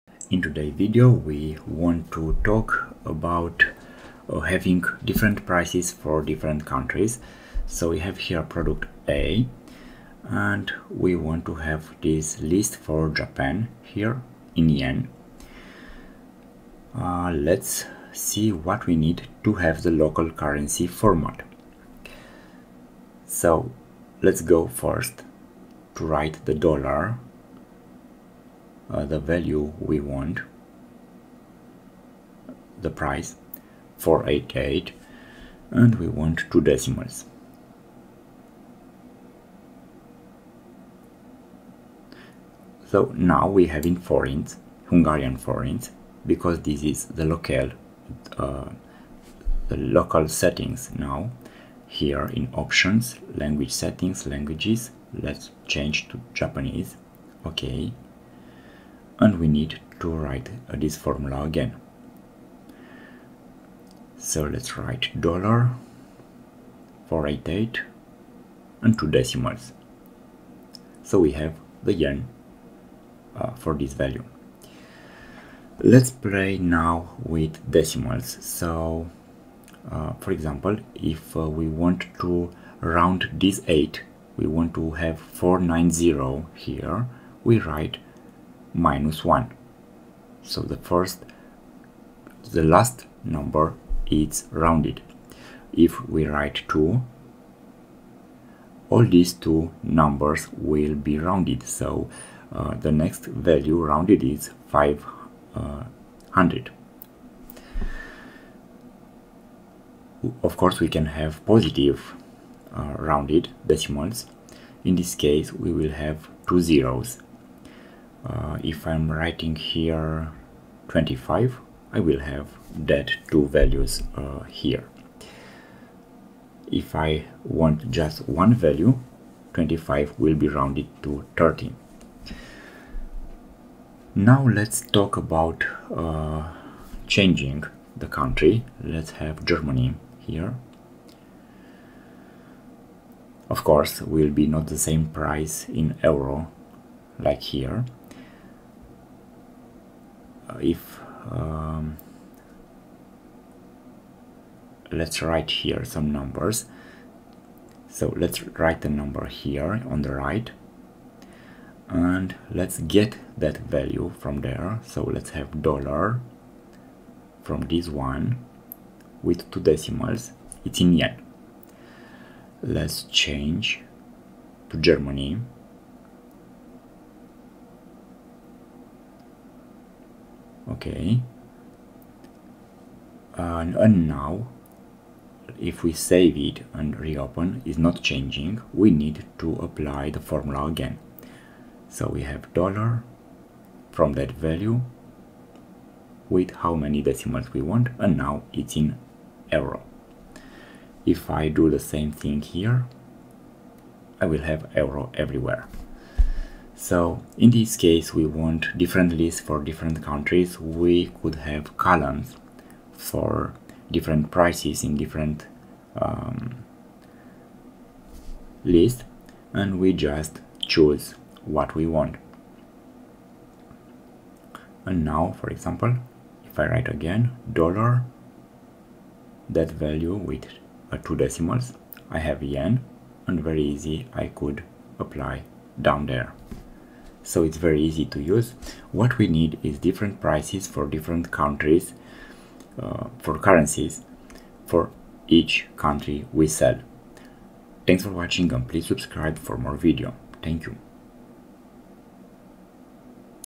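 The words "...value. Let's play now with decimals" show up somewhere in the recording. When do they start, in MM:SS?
01:13.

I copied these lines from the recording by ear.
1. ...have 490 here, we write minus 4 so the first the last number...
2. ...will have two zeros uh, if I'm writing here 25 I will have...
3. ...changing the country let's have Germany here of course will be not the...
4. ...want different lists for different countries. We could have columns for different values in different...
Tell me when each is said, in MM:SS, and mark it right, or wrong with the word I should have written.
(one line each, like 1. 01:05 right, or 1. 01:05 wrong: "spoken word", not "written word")
1. 01:24 wrong: "1", not "4"
2. 01:55 right
3. 02:17 right
4. 03:28 wrong: "prices", not "values".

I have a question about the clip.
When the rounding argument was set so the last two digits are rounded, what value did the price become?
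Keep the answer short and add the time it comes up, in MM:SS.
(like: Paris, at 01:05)
500, at 01:44.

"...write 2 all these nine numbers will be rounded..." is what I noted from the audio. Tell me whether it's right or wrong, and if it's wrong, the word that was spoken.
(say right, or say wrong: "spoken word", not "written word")
wrong: "two", not "nine".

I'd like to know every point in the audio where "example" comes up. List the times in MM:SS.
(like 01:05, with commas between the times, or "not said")
01:20, 03:45.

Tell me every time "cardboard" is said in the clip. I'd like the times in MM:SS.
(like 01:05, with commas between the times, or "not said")
not said.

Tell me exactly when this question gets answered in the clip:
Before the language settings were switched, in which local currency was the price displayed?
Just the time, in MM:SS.
00:44.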